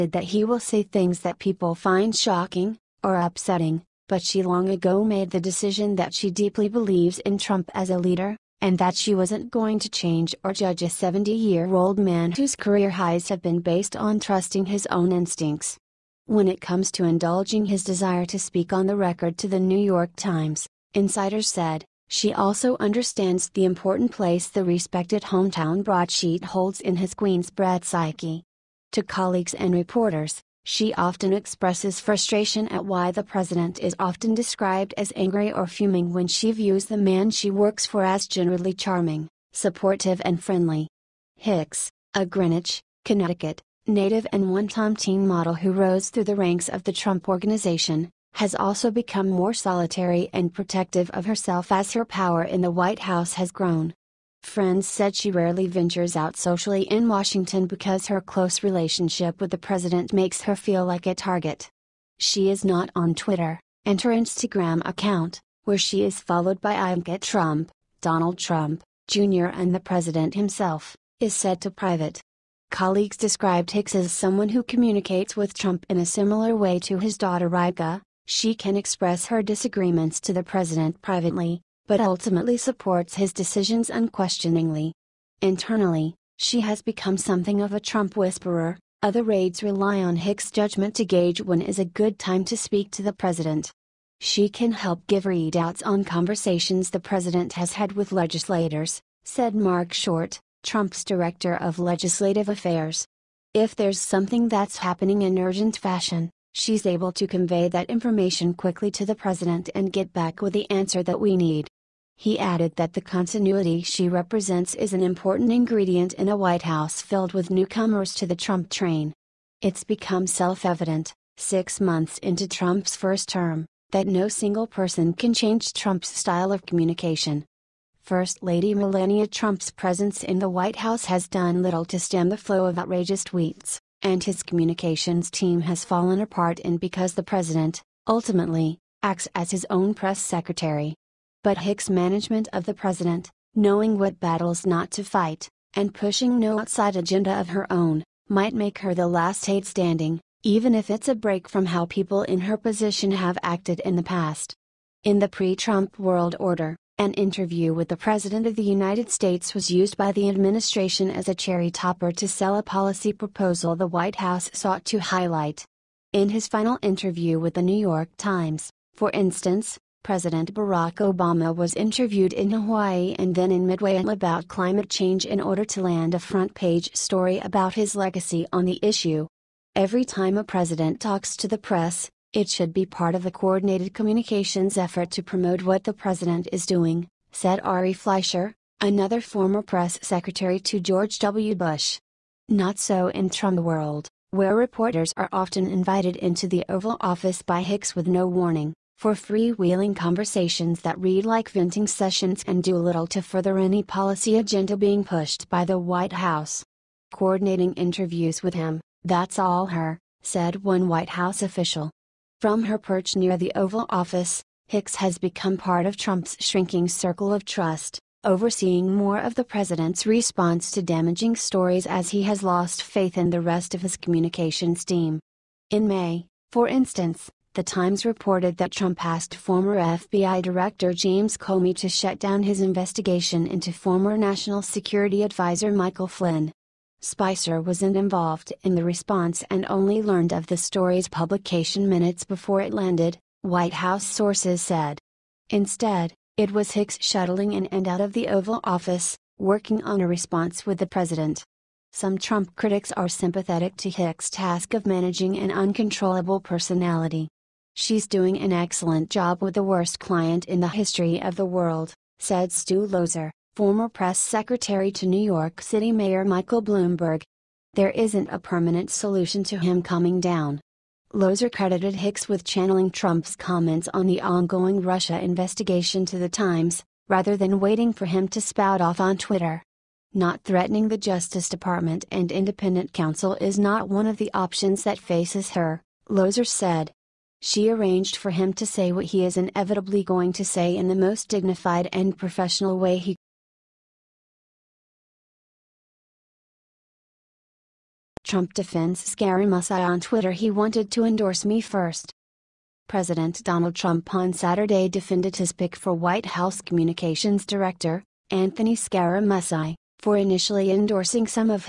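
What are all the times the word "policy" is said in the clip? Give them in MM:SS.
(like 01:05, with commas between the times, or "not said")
02:42, 03:23.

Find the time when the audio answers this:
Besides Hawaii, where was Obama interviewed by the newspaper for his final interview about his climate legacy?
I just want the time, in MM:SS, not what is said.
02:53.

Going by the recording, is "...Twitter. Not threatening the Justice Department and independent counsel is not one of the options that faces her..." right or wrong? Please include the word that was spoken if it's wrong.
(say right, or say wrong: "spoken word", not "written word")
right.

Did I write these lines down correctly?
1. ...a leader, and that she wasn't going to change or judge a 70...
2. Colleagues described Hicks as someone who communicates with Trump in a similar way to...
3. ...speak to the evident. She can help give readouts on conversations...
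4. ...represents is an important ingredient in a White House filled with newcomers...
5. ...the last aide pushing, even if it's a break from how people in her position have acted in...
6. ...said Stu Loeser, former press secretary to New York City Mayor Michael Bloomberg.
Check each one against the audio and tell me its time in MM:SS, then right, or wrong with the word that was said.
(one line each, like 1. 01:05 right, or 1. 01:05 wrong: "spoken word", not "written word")
1. 00:07 right
2. 01:12 right
3. 01:32 wrong: "president", not "evident"
4. 01:54 right
5. 02:28 wrong: "standing", not "pushing"
6. 04:22 right.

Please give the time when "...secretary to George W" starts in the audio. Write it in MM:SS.
03:09.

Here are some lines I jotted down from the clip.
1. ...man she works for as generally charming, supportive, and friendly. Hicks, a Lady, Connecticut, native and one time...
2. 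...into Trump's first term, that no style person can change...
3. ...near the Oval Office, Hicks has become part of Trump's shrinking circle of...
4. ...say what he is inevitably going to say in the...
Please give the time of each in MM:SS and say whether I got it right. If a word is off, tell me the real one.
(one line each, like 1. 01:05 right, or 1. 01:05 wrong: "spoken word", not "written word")
1. 00:36 wrong: "Greenwich", not "Lady"
2. 02:02 wrong: "single", not "style"
3. 03:33 right
4. 04:48 right.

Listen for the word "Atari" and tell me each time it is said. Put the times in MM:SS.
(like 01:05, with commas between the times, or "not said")
not said.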